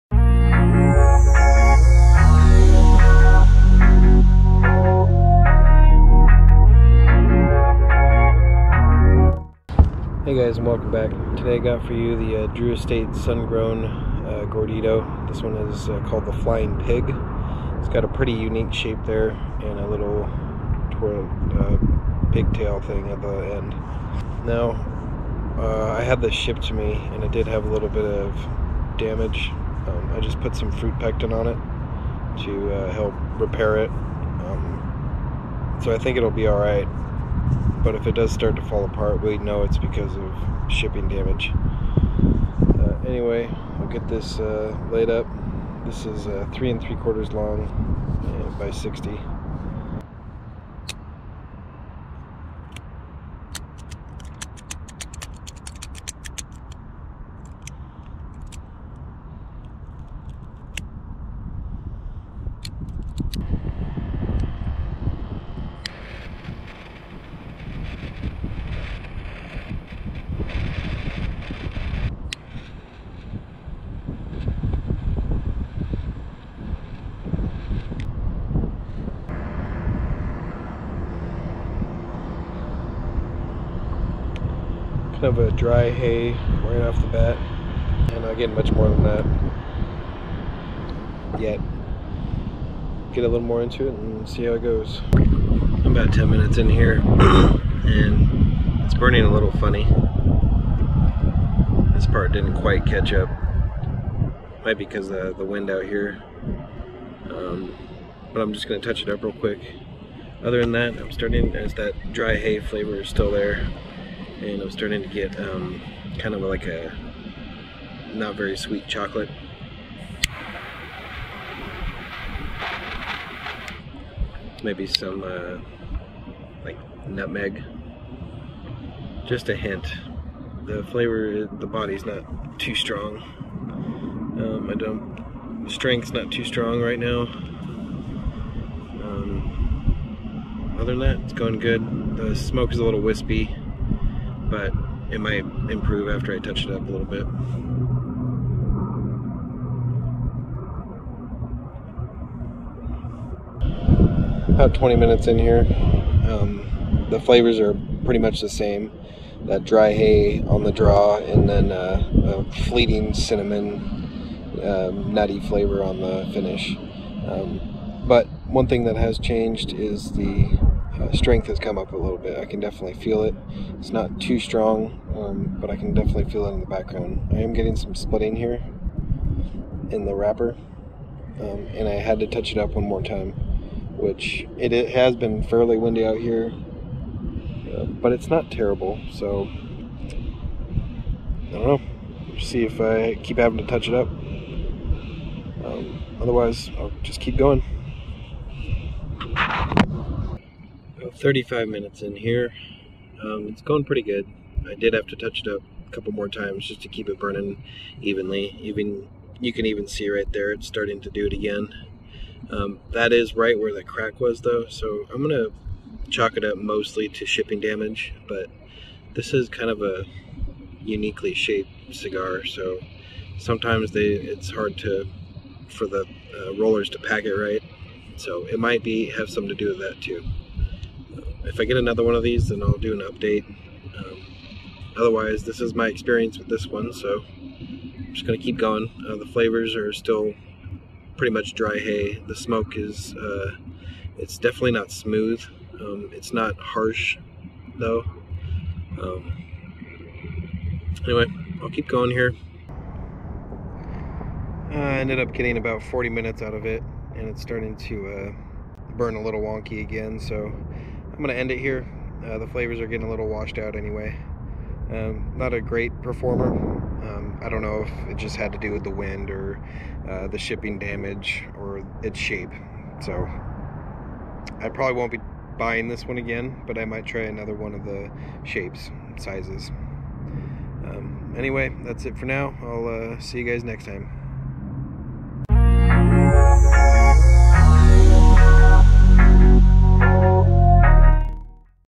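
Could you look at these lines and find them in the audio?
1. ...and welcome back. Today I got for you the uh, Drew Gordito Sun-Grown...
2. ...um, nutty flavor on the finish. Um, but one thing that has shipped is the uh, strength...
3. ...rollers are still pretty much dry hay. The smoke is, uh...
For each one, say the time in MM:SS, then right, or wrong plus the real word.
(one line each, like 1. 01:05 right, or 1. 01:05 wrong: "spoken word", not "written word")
1. 00:10 wrong: "Estate", not "Gordito"
2. 02:44 wrong: "changed", not "shipped"
3. 03:59 wrong: "flavors", not "rollers".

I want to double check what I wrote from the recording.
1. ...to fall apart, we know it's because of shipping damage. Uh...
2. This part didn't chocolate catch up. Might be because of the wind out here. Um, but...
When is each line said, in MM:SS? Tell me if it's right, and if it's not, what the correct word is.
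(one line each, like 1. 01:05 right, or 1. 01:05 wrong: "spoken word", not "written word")
1. 00:38 right
2. 01:41 wrong: "quite", not "chocolate".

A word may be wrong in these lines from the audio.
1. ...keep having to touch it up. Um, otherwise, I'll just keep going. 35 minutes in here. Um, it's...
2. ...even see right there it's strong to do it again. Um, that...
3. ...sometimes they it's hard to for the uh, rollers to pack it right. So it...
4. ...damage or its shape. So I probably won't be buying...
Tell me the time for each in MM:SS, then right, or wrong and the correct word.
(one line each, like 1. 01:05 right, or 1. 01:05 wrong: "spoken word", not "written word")
1. 03:13 right
2. 03:29 wrong: "starting", not "strong"
3. 03:43 right
4. 04:30 right.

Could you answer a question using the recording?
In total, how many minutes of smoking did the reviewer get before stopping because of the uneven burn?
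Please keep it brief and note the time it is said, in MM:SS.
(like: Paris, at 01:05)
40, at 04:15.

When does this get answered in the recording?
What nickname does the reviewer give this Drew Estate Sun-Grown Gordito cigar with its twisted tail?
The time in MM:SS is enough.
00:16.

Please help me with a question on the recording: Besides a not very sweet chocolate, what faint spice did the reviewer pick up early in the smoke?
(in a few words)
nutmeg.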